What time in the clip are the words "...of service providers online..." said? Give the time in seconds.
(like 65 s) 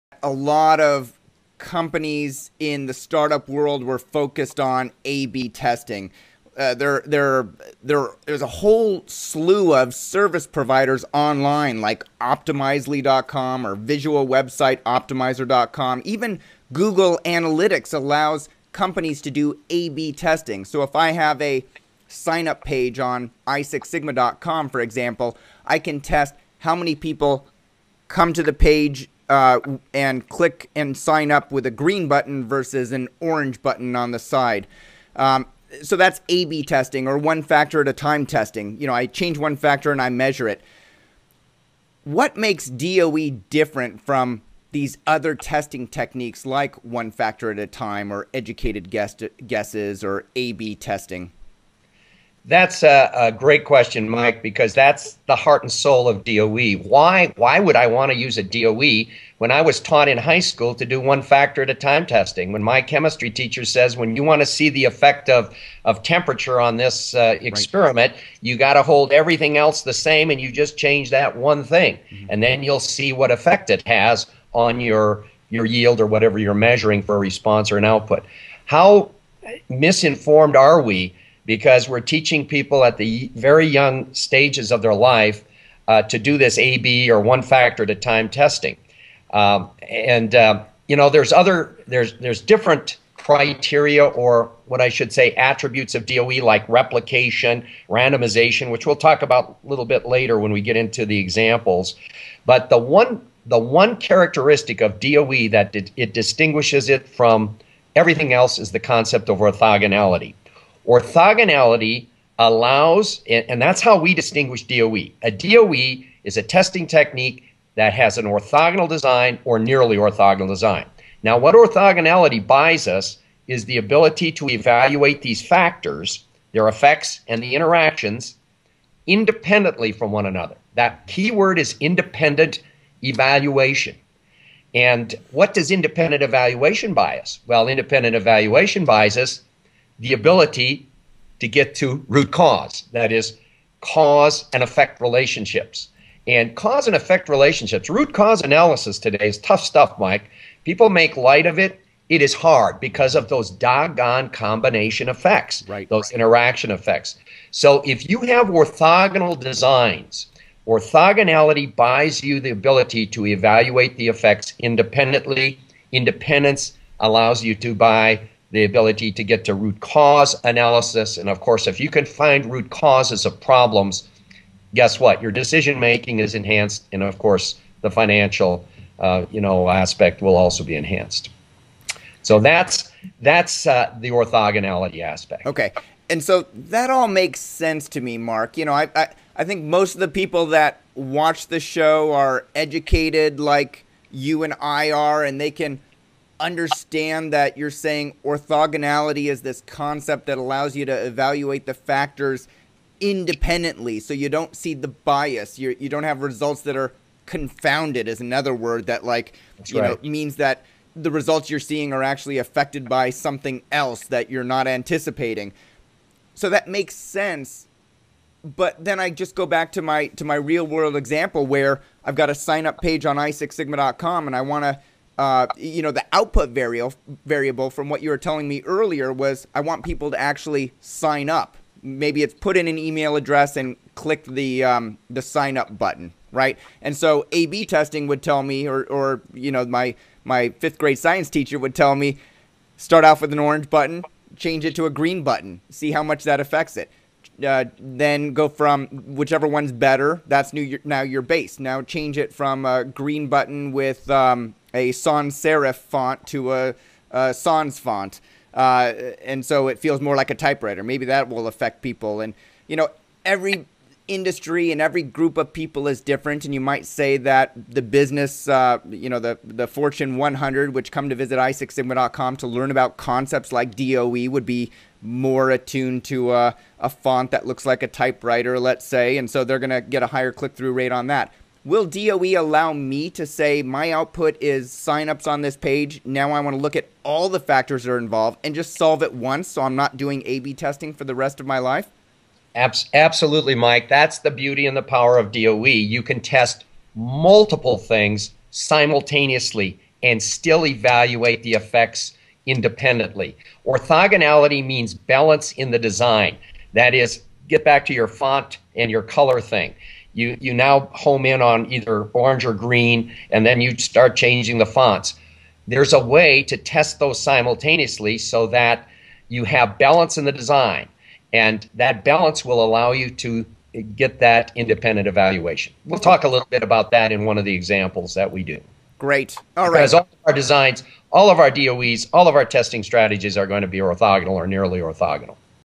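9 s.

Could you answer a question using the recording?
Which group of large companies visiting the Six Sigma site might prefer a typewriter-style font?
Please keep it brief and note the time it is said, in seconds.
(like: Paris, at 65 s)
Fortune 100, at 269 s.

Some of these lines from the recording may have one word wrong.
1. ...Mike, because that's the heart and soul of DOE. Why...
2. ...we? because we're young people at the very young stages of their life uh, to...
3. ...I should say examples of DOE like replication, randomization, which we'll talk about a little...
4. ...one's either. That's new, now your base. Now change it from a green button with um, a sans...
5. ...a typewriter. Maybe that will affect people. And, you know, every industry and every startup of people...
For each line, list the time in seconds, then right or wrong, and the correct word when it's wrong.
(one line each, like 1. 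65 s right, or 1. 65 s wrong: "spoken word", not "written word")
1. 54 s right
2. 80 s wrong: "teaching", not "young"
3. 94 s wrong: "attributes", not "examples"
4. 249 s wrong: "better", not "either"
5. 260 s wrong: "group", not "startup".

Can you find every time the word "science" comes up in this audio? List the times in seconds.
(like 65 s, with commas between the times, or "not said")
240 s.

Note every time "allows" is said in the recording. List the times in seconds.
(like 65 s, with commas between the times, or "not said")
17 s, 112 s, 166 s, 200 s, 282 s, 322 s.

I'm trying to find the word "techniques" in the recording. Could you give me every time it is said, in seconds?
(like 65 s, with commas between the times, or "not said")
45 s, 116 s.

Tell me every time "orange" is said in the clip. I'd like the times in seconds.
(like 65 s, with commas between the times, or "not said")
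33 s, 243 s, 312 s.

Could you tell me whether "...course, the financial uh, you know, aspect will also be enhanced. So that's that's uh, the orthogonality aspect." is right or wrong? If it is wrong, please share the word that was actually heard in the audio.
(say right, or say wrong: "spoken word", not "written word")
right.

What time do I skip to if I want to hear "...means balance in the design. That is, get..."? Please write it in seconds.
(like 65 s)
304 s.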